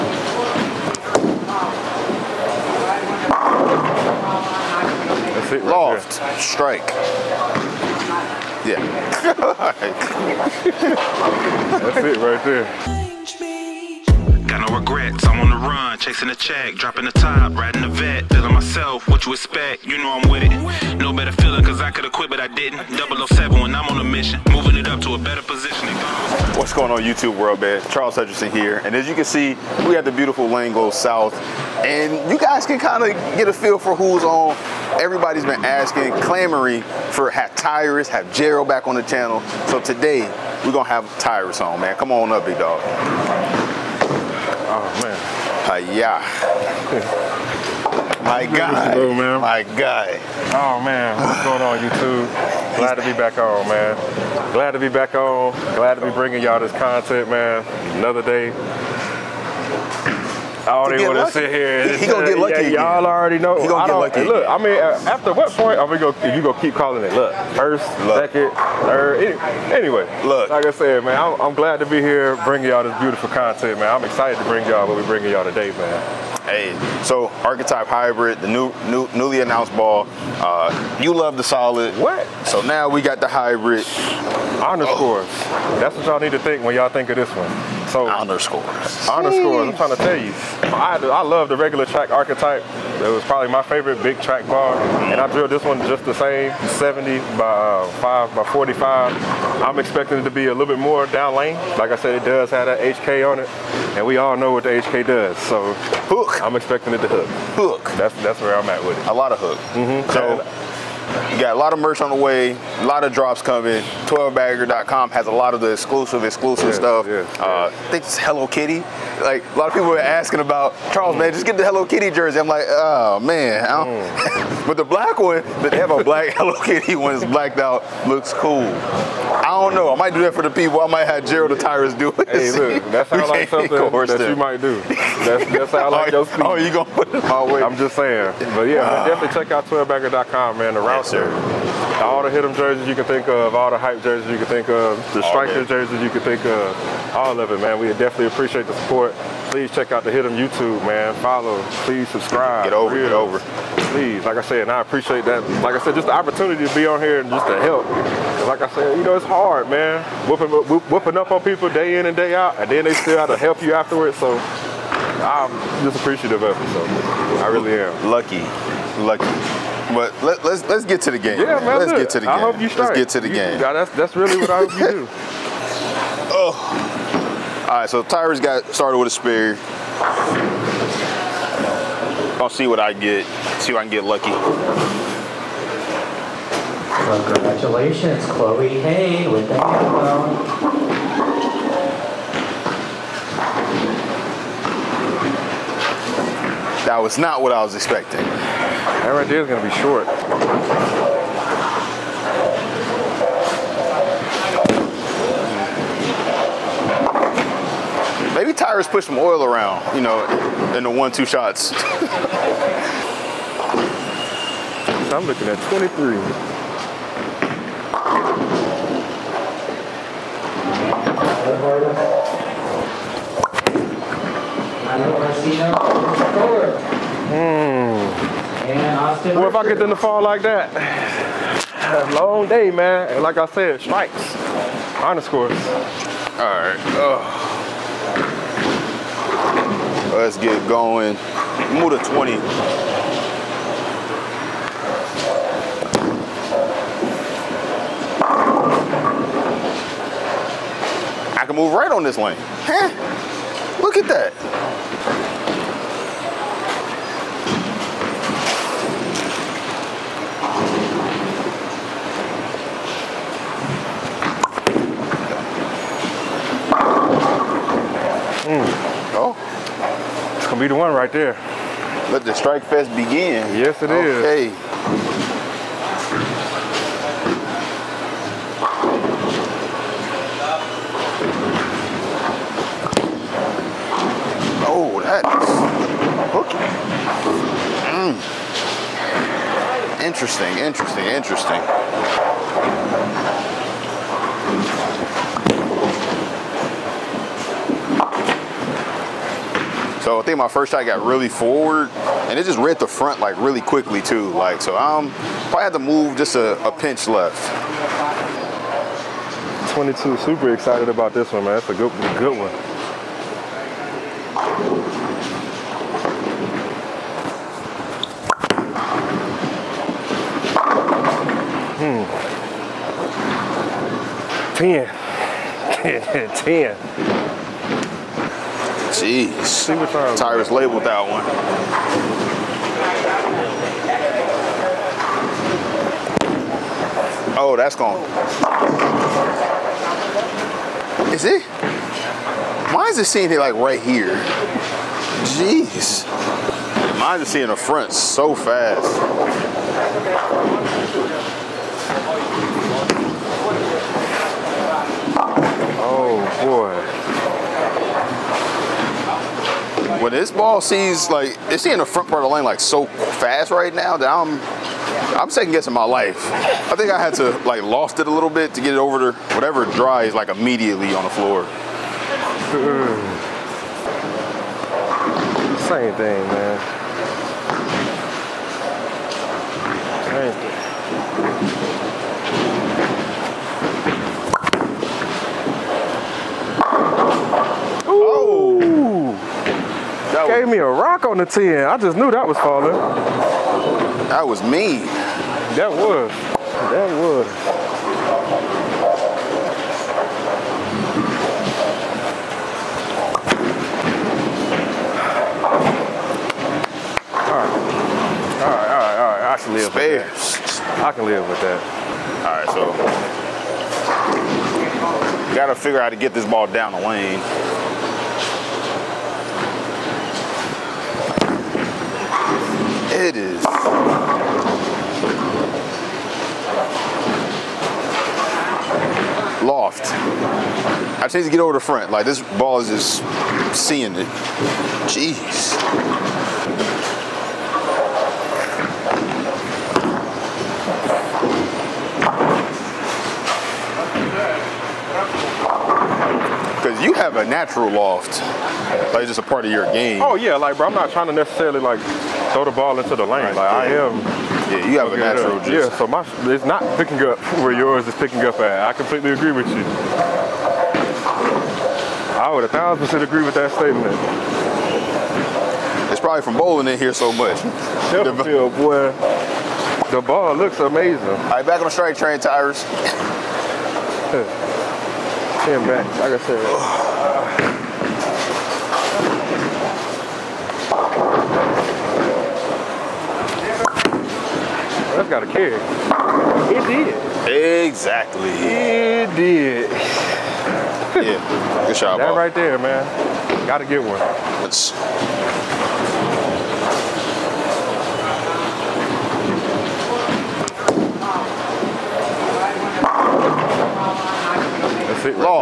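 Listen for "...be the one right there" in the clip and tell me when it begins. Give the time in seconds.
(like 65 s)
270 s.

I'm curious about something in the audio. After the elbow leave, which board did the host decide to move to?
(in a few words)
20.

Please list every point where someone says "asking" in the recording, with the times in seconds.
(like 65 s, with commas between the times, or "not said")
35 s, 119 s.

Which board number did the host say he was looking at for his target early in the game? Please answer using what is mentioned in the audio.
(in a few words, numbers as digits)
23.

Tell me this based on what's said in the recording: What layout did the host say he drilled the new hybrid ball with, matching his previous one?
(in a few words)
5 by 45.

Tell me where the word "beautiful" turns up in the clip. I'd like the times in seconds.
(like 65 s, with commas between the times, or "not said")
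30 s, 73 s.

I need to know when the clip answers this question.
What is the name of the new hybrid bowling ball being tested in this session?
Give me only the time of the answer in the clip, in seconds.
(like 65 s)
77 s.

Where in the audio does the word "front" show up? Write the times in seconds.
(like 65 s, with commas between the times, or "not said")
302 s, 347 s, 361 s, 431 s.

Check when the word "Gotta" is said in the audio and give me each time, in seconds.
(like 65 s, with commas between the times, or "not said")
415 s, 493 s.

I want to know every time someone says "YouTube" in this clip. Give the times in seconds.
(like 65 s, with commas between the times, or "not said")
27 s, 51 s, 150 s.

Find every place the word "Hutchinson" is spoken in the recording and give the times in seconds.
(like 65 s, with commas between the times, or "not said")
28 s.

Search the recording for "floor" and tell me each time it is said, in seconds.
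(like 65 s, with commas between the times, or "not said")
371 s.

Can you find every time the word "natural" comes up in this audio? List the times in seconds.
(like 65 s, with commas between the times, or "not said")
447 s, 454 s.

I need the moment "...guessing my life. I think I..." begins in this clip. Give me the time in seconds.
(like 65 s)
365 s.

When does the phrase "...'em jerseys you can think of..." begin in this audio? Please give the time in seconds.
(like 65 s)
142 s.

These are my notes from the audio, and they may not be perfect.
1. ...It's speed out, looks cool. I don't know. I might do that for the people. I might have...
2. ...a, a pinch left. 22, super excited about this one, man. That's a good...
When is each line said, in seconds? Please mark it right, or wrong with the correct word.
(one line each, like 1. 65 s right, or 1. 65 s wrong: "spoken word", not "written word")
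1. 127 s wrong: "blacked", not "speed"
2. 306 s right.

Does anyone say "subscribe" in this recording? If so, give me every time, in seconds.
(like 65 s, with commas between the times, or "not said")
152 s.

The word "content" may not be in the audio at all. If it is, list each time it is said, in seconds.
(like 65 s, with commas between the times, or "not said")
56 s, 73 s.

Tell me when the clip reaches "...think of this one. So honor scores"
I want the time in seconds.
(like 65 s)
86 s.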